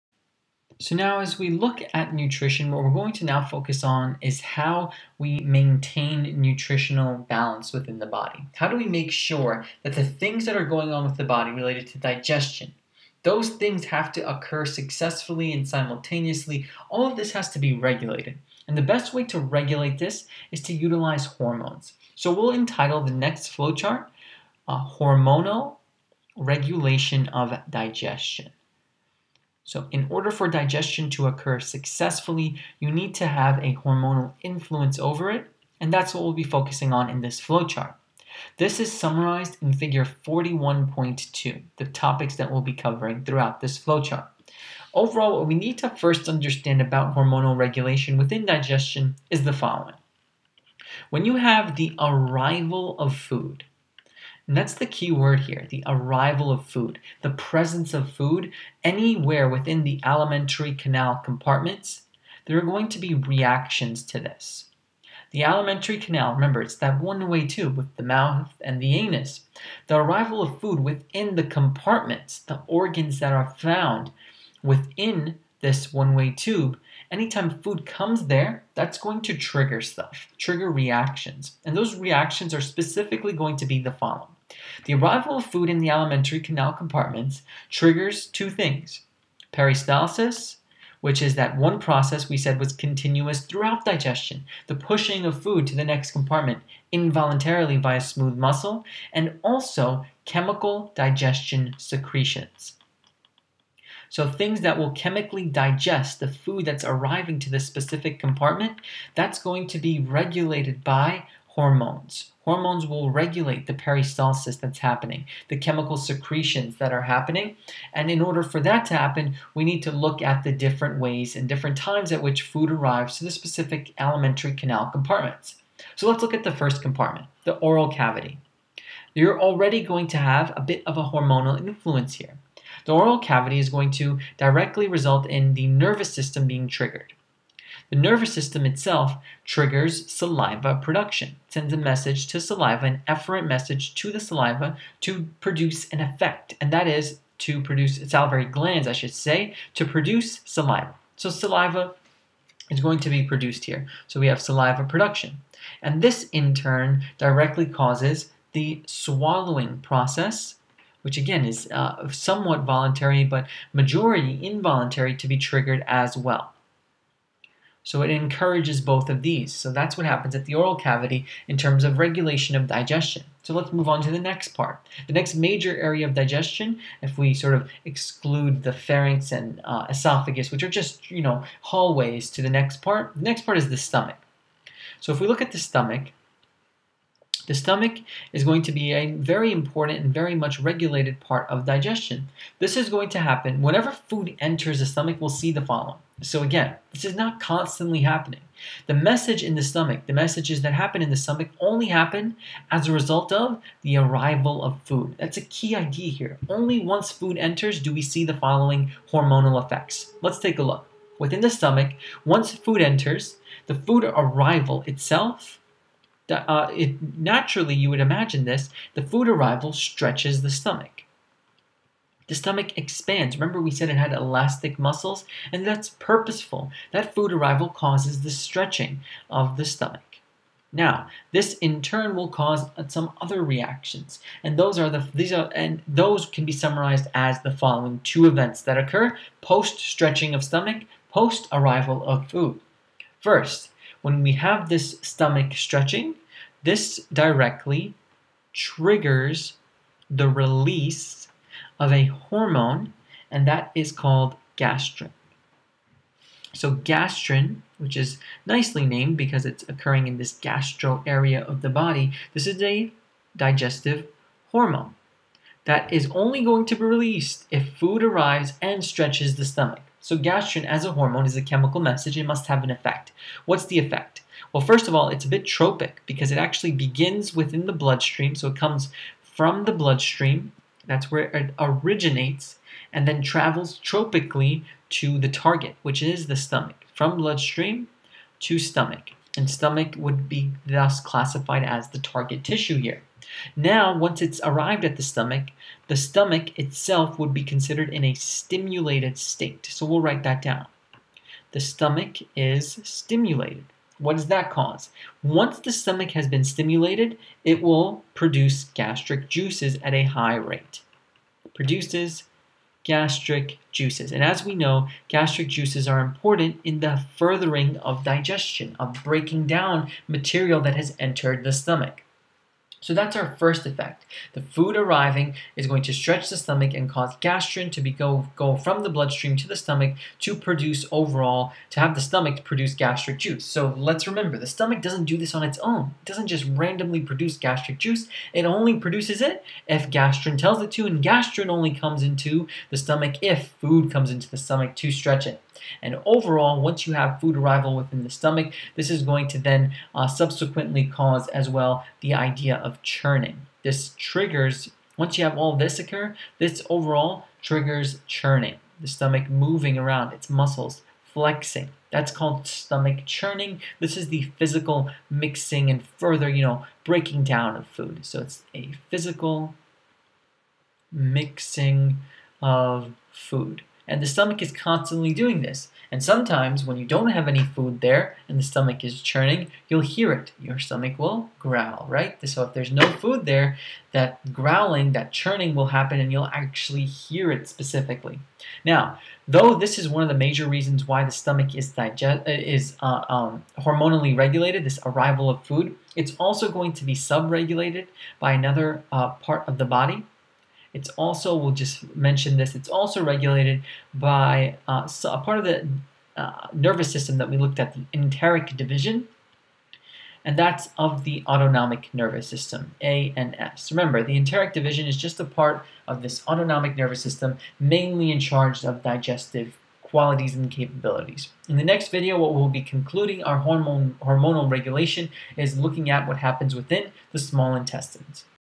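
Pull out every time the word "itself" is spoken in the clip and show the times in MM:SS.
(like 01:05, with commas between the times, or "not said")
02:18, 03:34, 04:56.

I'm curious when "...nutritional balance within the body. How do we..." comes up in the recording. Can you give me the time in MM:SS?
00:06.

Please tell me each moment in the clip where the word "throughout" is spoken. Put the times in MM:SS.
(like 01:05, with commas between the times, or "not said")
00:43, 01:33.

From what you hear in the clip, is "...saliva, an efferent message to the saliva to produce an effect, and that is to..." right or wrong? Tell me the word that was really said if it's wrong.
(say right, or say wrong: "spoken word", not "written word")
right.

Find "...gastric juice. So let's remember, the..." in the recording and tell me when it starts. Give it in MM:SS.
05:32.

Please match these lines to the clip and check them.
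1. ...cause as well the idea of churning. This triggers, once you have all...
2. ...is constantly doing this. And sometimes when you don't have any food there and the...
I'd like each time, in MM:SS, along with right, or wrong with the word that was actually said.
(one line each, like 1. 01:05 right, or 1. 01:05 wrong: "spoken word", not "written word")
1. 05:50 right
2. 06:14 right.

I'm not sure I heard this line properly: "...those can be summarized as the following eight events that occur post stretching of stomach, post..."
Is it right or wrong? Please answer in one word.
wrong.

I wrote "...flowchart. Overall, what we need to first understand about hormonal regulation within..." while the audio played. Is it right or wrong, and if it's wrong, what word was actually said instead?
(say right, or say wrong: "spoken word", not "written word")
right.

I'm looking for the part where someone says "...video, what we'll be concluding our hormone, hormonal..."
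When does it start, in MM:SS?
07:01.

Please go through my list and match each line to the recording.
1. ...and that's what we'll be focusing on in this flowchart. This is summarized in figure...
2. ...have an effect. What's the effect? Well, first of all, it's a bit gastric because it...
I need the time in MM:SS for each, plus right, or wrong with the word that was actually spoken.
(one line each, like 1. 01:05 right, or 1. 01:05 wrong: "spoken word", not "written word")
1. 00:35 right
2. 04:32 wrong: "tropic", not "gastric".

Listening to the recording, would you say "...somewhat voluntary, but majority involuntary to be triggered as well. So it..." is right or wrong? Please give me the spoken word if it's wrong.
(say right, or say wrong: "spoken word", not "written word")
right.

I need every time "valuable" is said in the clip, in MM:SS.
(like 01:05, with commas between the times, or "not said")
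not said.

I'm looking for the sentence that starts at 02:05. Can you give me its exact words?
So let's look at the first compartment, the oral cavity.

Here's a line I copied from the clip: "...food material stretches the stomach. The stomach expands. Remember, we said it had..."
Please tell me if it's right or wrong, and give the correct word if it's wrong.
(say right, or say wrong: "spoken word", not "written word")
wrong: "arrival", not "material".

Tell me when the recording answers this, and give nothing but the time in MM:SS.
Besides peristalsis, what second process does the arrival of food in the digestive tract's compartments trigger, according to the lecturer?
01:40.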